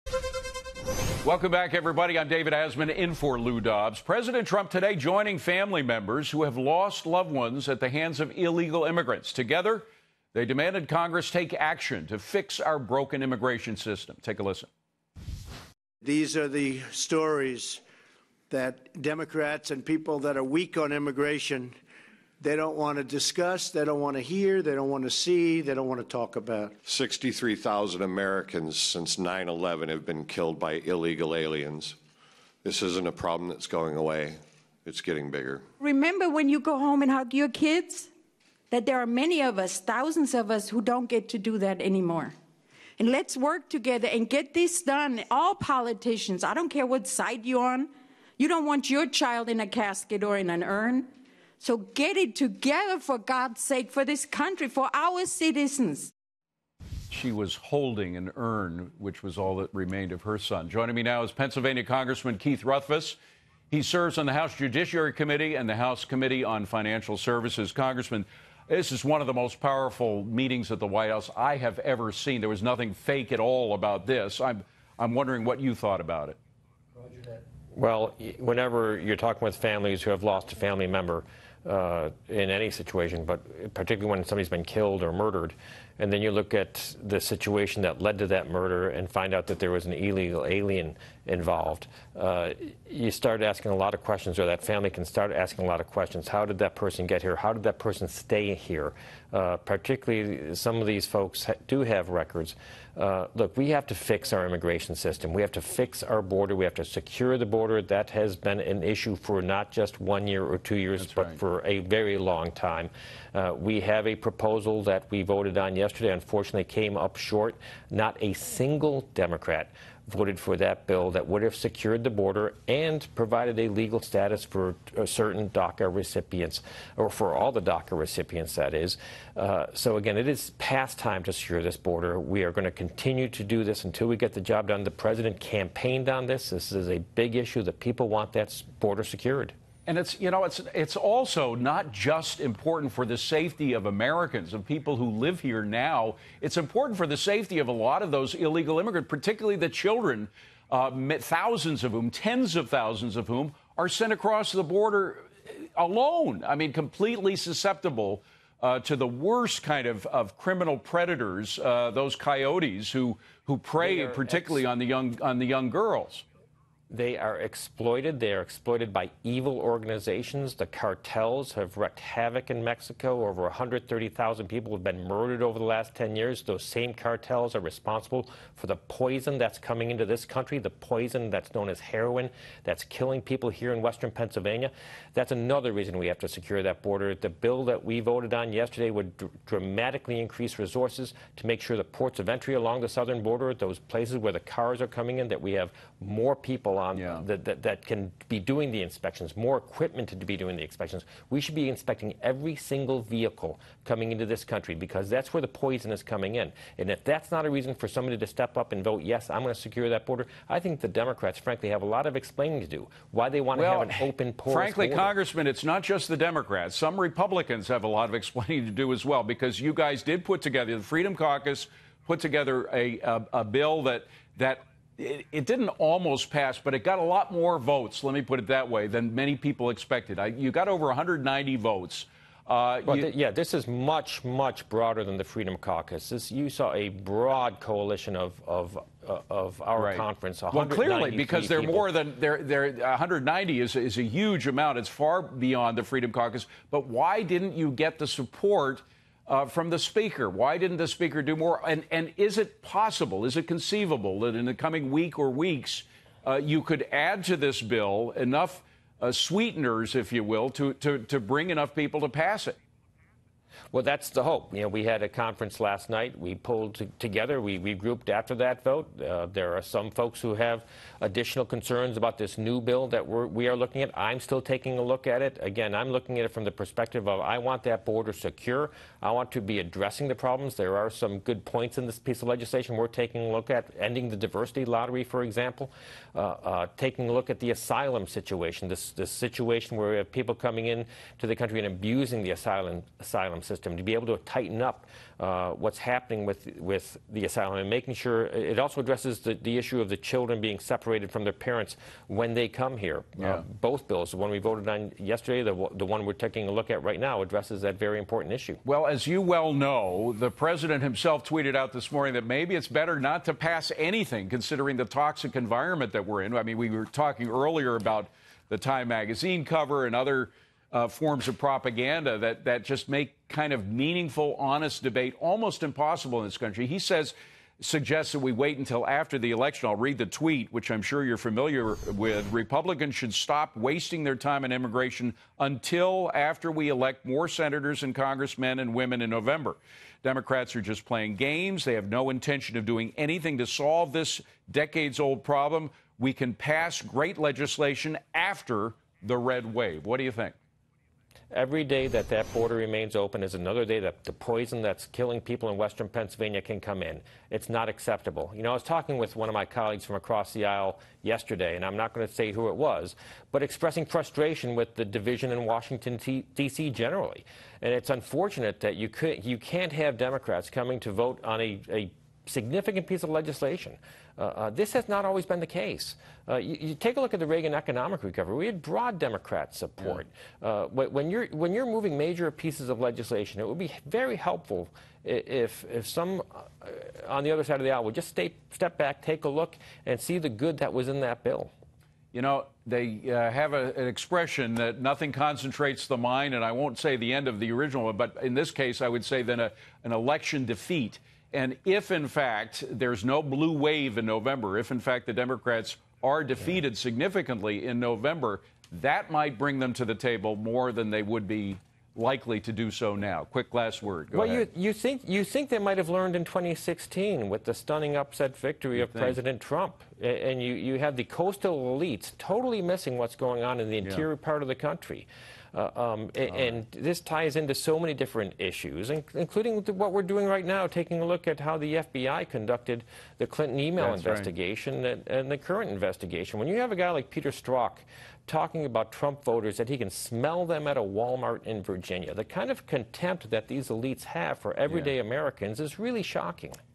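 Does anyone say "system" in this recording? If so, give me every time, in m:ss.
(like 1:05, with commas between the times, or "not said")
0:13, 1:44, 4:53.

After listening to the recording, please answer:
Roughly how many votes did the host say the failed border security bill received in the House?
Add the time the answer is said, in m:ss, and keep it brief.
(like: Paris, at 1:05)
Over 190, at 3:50.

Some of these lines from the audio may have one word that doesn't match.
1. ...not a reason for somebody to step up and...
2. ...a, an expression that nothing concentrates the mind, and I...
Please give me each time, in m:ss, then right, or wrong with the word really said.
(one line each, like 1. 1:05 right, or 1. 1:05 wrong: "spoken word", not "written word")
1. 3:27 right
2. 6:33 right.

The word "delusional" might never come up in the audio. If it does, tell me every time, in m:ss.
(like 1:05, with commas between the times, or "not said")
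not said.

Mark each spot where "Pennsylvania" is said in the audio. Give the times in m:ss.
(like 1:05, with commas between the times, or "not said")
1:01, 3:04, 5:55.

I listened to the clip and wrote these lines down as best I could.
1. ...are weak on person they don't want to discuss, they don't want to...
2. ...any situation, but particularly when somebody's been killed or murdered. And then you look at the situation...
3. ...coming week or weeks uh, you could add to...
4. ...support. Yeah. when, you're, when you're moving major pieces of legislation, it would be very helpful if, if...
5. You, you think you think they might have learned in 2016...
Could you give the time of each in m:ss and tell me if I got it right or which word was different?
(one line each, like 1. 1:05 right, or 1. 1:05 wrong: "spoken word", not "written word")
1. 0:20 wrong: "immigration", not "person"
2. 1:22 right
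3. 4:14 right
4. 6:19 right
5. 6:54 right.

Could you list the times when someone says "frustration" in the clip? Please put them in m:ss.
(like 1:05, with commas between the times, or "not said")
6:03.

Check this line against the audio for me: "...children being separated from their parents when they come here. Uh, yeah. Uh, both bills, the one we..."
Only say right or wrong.
right.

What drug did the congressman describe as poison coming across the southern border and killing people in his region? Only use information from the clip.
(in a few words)
heroin.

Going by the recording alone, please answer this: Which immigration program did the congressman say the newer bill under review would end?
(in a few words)
Diversity lottery.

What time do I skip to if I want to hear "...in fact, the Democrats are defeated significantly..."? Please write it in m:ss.
6:44.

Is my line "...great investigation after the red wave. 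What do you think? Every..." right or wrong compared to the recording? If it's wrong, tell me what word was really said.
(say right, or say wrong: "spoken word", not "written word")
wrong: "legislation", not "investigation".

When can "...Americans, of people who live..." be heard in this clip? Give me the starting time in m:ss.
2:23.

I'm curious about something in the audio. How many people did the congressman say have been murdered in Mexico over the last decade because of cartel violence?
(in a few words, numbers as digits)
Over 130,000.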